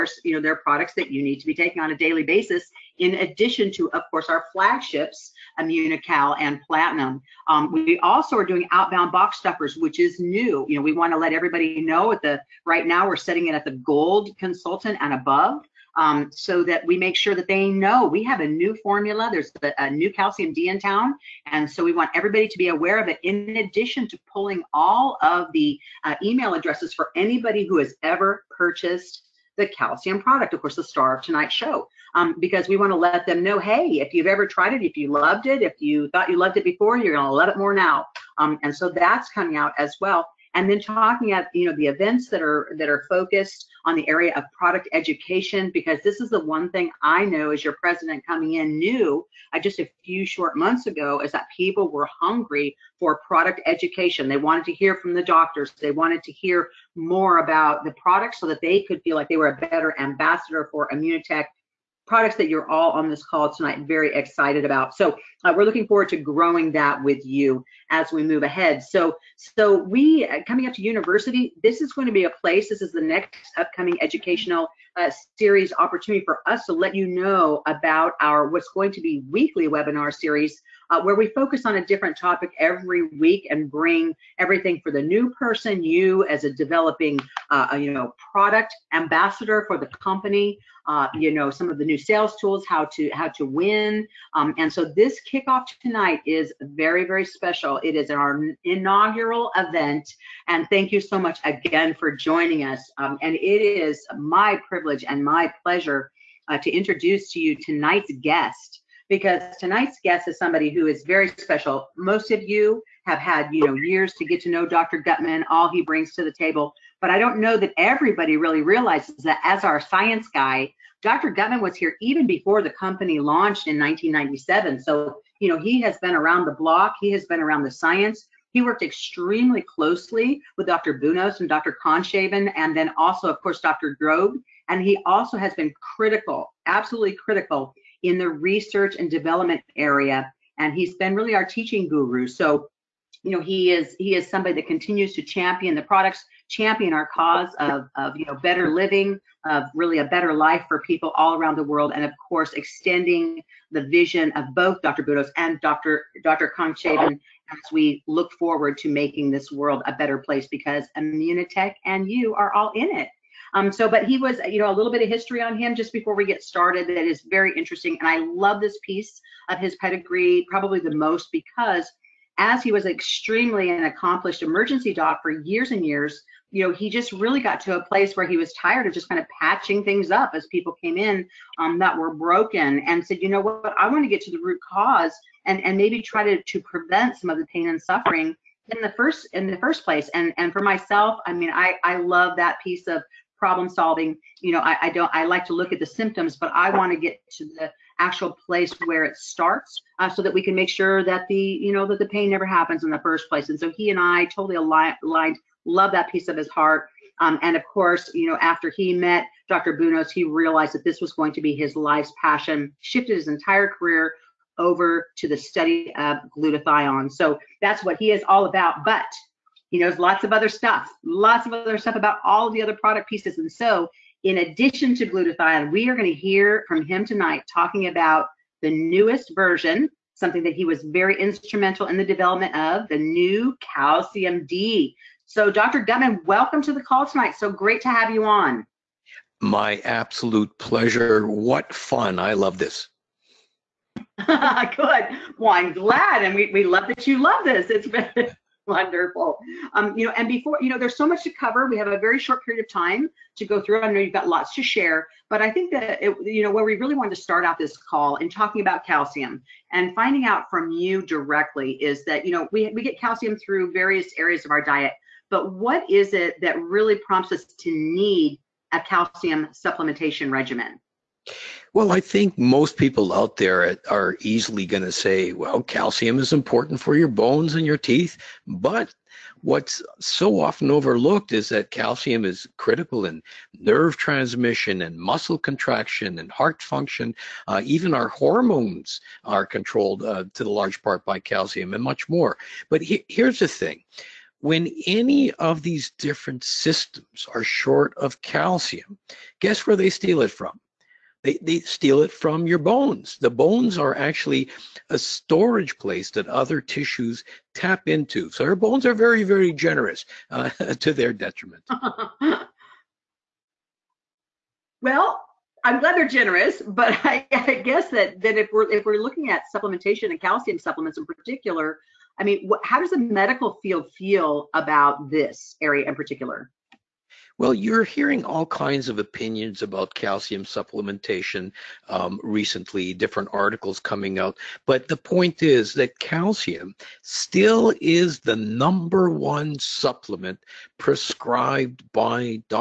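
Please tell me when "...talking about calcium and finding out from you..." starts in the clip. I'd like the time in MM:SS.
04:18.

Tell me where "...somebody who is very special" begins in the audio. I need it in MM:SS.
01:50.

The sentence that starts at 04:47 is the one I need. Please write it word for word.
Uh, even our hormones are controlled uh, to the large part by calcium and much more.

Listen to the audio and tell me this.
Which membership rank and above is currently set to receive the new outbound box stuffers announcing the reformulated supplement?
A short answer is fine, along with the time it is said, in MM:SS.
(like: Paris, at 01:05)
Gold consultant, at 00:13.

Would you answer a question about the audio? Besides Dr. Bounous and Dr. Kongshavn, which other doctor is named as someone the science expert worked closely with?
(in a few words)
Dr. Grobe.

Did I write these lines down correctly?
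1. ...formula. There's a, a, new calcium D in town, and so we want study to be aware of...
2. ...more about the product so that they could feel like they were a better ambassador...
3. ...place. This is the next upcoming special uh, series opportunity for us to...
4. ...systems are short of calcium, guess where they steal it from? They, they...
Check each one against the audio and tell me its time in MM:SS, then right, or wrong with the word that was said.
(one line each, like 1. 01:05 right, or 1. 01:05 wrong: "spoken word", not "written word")
1. 00:18 wrong: "everybody", not "study"
2. 00:56 right
3. 01:12 wrong: "educational", not "special"
4. 04:56 right.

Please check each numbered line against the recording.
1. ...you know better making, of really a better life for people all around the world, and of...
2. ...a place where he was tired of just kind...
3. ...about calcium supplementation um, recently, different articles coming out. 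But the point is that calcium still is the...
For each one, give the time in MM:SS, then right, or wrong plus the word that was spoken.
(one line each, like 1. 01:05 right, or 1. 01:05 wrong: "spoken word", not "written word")
1. 02:28 wrong: "living", not "making"
2. 02:57 right
3. 05:29 right.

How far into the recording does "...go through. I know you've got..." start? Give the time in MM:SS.
04:13.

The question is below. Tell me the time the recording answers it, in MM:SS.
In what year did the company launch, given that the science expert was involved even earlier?
02:03.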